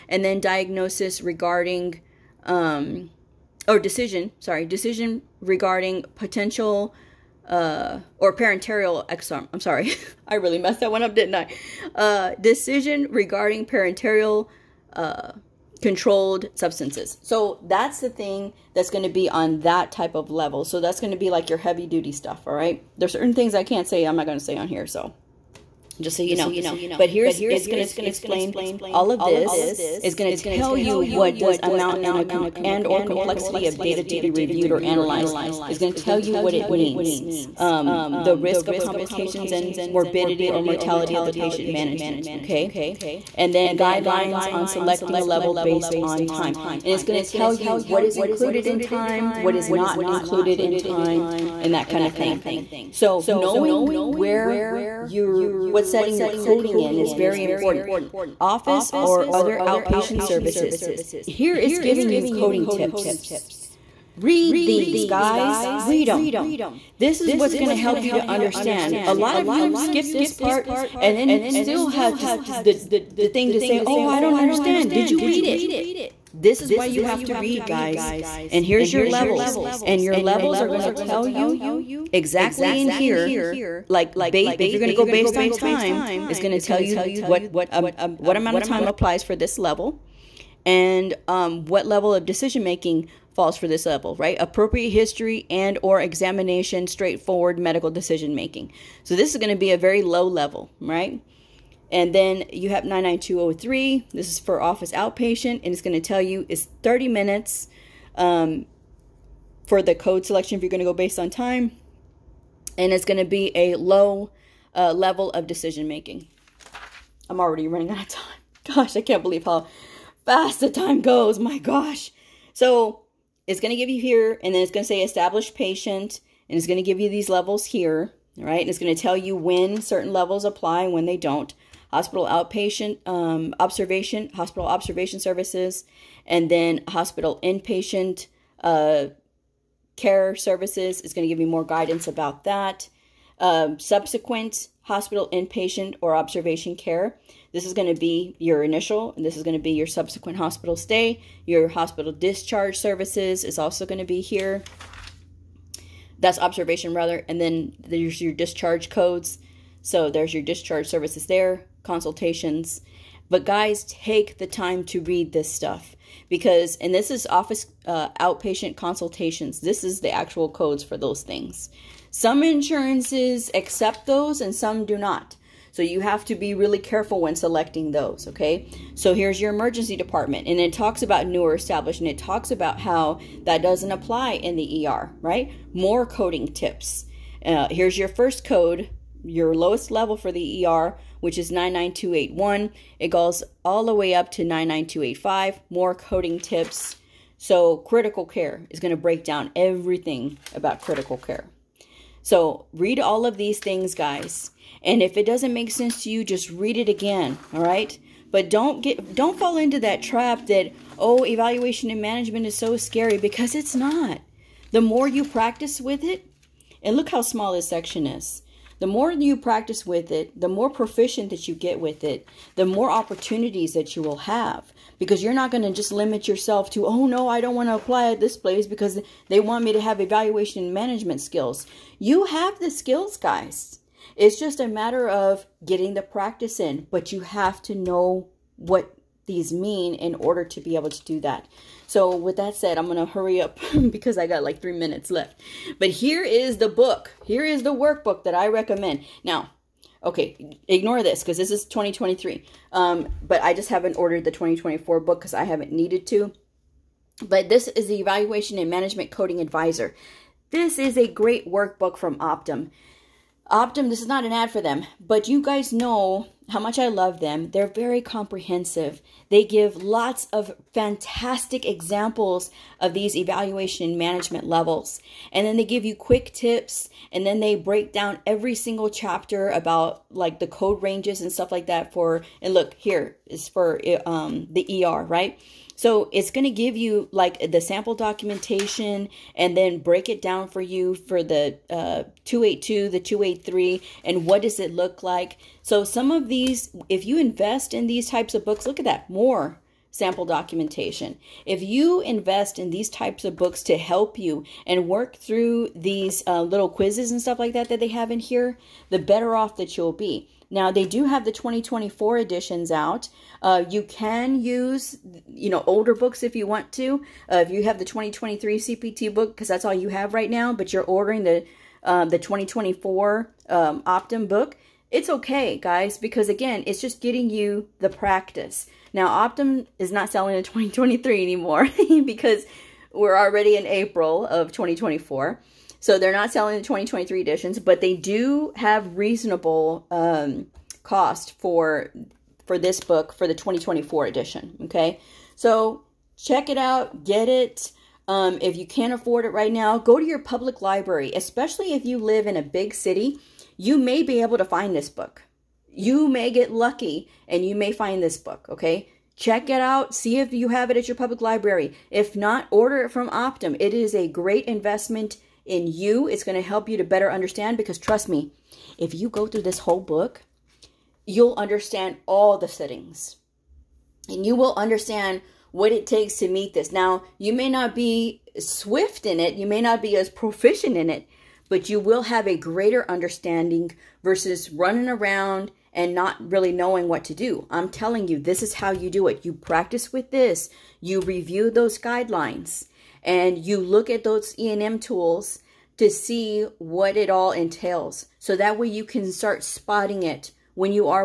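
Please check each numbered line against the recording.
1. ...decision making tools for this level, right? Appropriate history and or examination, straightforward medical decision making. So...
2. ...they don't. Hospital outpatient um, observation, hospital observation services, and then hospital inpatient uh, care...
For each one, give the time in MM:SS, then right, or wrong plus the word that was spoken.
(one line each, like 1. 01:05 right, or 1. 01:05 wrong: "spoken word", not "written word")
1. 01:32 wrong: "falls", not "tools"
2. 02:11 right.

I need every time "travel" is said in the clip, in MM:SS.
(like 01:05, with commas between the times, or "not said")
not said.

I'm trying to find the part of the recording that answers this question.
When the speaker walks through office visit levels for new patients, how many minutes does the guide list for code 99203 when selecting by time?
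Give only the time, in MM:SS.
01:46.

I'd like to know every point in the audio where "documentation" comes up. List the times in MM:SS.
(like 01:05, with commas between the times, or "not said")
04:47, 05:00.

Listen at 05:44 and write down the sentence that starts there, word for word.
Okay, so check it out, get it.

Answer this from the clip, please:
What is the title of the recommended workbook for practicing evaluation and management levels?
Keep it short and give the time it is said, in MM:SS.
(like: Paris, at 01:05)
Evaluation and Management Coding Advisor, at 04:17.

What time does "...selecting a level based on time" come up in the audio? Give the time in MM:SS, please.
00:44.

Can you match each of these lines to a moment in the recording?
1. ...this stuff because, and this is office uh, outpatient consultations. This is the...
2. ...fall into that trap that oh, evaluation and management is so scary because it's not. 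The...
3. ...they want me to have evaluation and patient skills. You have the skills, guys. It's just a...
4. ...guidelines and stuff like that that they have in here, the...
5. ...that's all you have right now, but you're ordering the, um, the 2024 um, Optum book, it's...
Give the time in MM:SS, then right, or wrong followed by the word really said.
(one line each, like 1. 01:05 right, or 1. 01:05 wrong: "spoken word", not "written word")
1. 02:45 right
2. 03:29 right
3. 03:49 wrong: "management", not "patient"
4. 05:06 wrong: "quizzes", not "guidelines"
5. 05:19 right.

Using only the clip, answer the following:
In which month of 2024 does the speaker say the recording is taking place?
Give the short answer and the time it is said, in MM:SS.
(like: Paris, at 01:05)
April, at 05:33.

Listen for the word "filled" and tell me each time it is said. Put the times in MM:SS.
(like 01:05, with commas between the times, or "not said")
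not said.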